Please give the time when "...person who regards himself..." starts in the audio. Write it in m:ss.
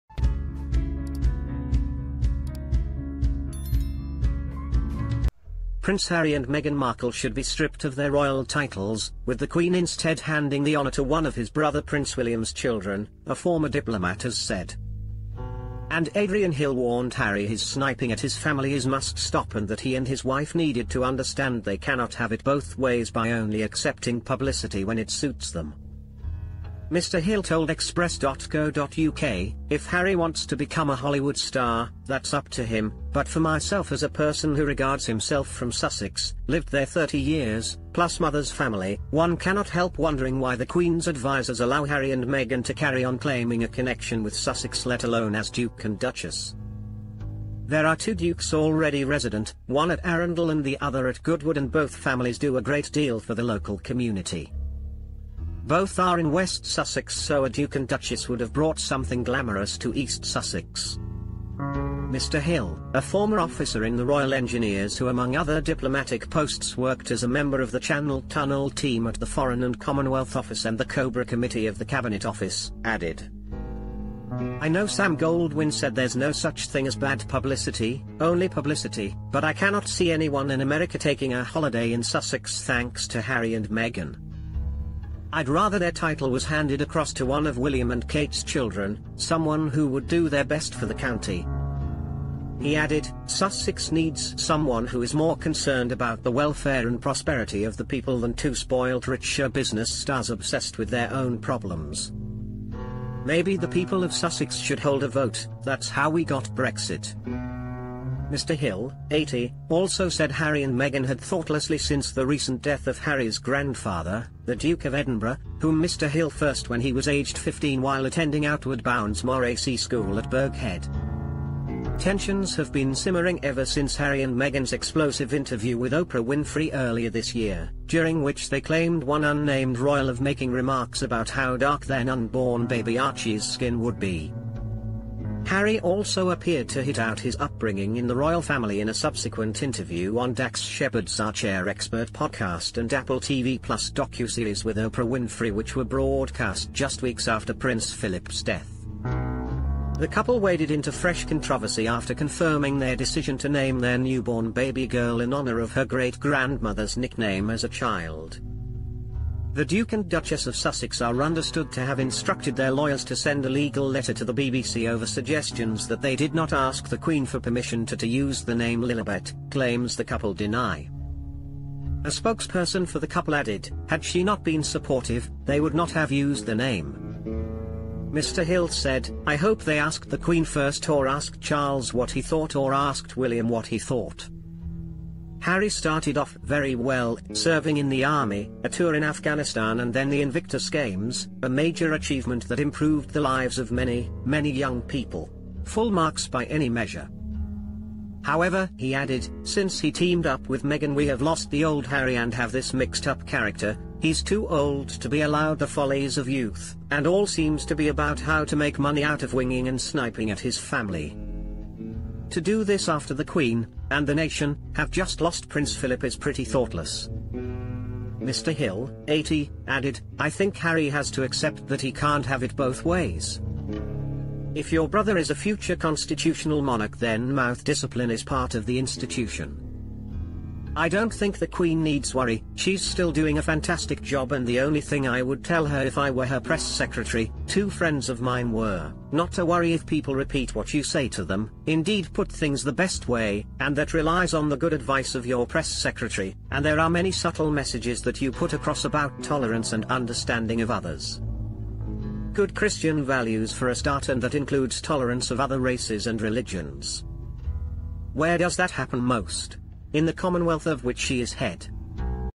0:34.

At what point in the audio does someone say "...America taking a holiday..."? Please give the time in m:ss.
1:20.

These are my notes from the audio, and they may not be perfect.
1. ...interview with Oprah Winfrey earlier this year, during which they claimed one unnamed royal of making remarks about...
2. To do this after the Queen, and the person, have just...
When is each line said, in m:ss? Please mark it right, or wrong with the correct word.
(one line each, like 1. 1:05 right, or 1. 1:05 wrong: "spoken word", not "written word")
1. 2:05 right
2. 3:32 wrong: "nation", not "person".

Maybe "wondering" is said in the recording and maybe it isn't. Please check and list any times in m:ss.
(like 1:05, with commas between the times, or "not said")
0:39.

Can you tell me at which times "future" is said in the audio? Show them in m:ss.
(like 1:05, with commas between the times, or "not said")
3:45.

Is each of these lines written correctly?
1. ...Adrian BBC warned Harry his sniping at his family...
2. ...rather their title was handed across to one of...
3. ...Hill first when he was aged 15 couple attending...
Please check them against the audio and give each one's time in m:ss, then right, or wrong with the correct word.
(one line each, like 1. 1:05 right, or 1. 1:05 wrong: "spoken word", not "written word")
1. 0:16 wrong: "Hill", not "BBC"
2. 1:25 right
3. 1:56 wrong: "while", not "couple".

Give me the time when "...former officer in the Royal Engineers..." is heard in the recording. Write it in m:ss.
1:03.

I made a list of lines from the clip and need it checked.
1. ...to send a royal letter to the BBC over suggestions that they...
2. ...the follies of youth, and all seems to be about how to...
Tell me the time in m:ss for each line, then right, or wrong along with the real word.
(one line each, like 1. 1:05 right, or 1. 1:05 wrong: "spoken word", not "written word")
1. 2:43 wrong: "legal", not "royal"
2. 3:25 right.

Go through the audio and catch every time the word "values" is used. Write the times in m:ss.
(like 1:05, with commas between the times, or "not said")
4:13.